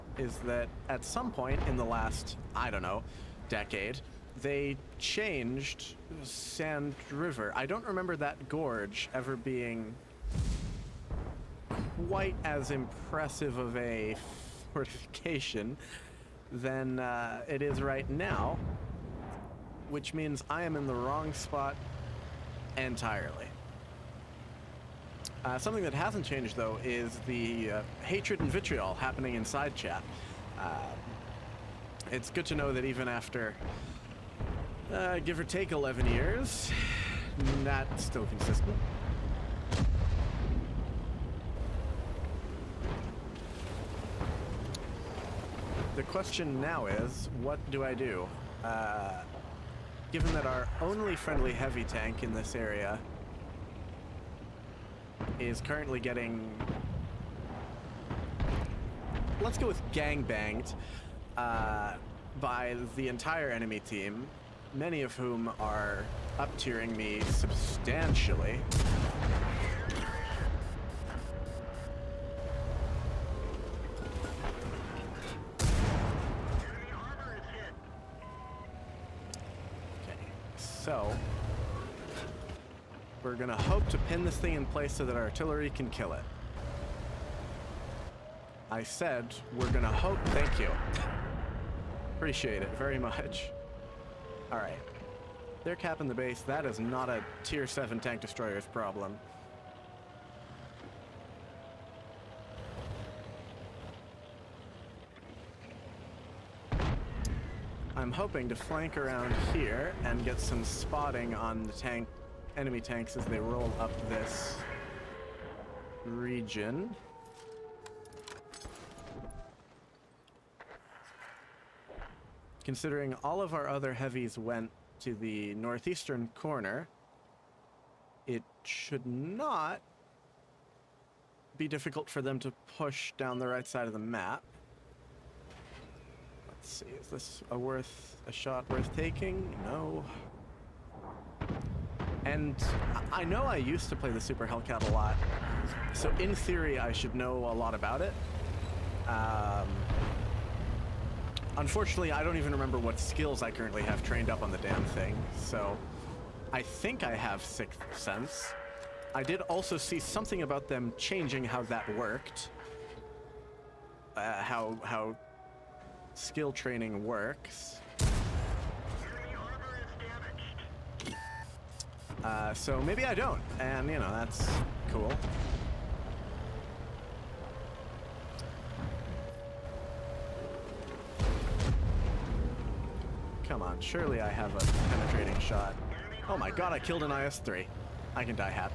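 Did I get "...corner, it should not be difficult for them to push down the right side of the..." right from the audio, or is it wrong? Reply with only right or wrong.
right.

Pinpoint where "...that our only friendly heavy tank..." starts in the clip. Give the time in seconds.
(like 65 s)
50 s.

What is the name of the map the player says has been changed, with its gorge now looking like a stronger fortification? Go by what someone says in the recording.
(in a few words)
Sand River.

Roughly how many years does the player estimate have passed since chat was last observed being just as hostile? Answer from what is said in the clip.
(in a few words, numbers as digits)
11.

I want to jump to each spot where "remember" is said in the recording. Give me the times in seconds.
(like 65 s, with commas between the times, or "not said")
7 s, 152 s.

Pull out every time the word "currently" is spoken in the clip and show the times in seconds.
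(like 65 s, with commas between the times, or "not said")
55 s, 153 s.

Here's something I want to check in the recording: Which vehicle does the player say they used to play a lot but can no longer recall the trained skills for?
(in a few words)
Super Hellcat.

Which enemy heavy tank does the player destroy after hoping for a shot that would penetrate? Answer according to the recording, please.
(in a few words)
IS-3.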